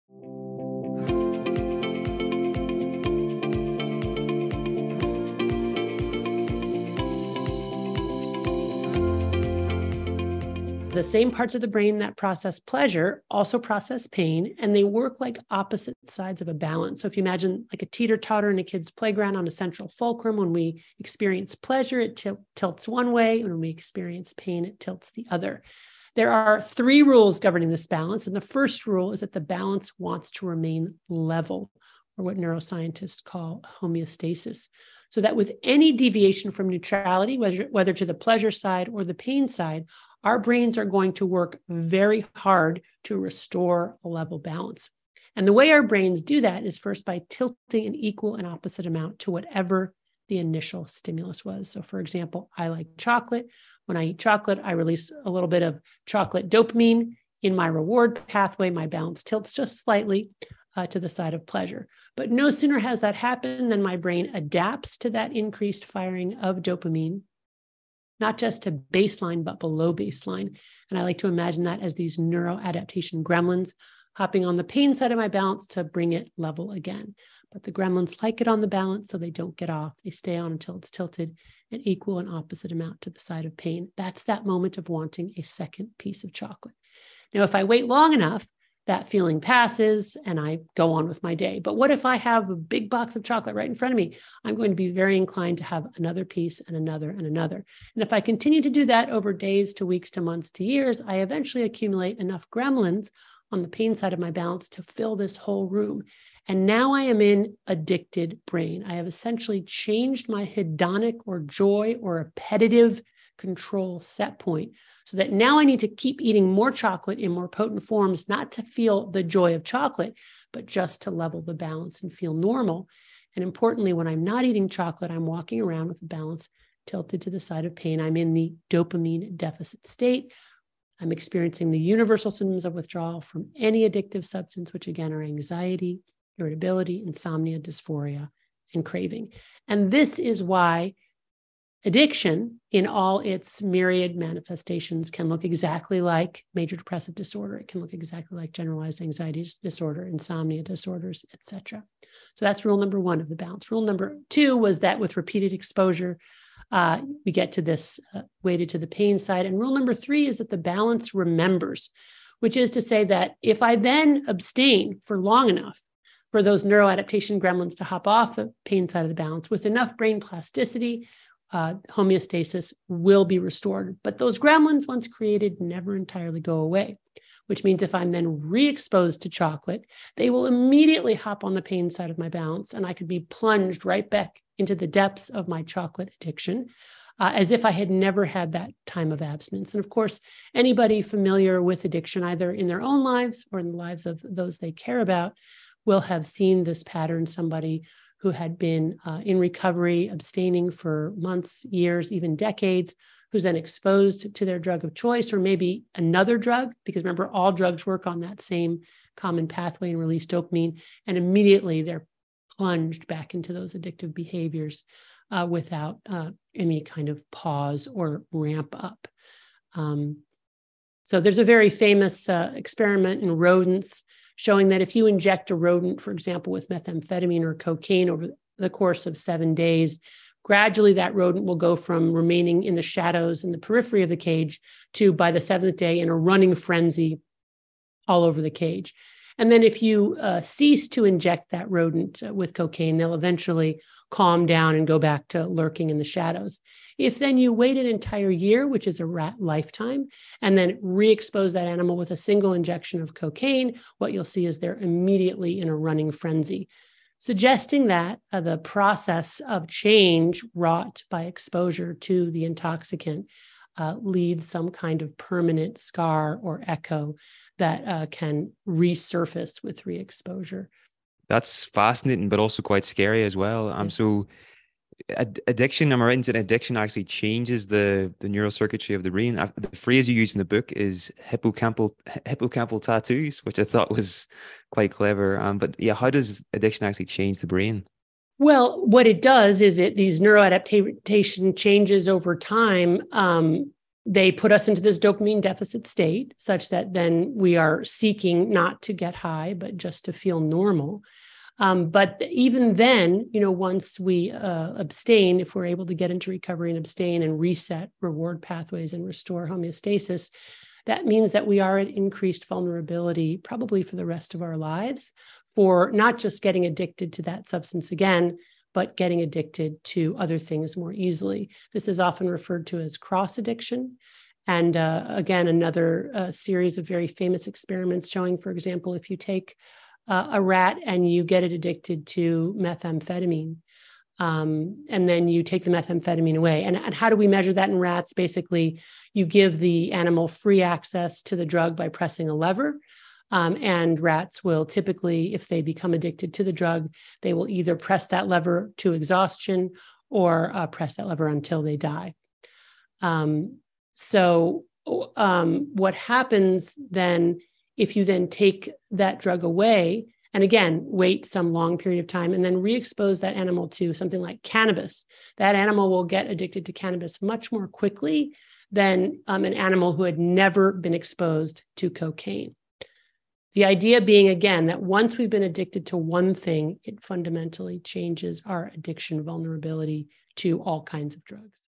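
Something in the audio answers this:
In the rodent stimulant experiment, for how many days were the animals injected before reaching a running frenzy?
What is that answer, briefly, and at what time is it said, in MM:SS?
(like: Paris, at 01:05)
7, at 03:49.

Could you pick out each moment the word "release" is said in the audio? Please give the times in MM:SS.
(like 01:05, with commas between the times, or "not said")
00:54, 03:29.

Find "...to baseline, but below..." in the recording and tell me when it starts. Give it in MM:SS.
01:08.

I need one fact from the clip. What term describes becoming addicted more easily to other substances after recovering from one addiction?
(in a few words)
cross addiction.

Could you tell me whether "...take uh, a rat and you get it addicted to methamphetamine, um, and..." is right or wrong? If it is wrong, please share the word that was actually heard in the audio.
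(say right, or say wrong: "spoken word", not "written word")
right.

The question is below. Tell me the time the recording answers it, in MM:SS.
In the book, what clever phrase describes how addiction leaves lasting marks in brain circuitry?
04:42.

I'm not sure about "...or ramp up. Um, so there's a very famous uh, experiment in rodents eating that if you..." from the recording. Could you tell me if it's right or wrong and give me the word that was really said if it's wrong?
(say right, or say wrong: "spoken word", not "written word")
wrong: "showing", not "eating".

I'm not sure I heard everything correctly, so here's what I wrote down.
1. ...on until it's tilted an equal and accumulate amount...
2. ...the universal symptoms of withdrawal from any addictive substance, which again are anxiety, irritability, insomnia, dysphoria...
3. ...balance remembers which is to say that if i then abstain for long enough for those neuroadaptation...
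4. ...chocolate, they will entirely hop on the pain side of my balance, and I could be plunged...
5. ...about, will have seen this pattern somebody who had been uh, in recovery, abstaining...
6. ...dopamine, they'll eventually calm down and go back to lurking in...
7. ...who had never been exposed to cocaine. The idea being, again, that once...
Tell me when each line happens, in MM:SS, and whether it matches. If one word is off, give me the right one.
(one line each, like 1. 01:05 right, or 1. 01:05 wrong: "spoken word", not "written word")
1. 01:20 wrong: "opposite", not "accumulate"
2. 02:11 right
3. 02:40 right
4. 02:59 wrong: "immediately", not "entirely"
5. 03:15 right
6. 04:02 wrong: "cocaine", not "dopamine"
7. 06:09 right.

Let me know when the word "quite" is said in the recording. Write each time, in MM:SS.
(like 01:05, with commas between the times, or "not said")
04:32, 04:44.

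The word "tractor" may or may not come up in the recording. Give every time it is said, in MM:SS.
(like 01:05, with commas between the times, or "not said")
not said.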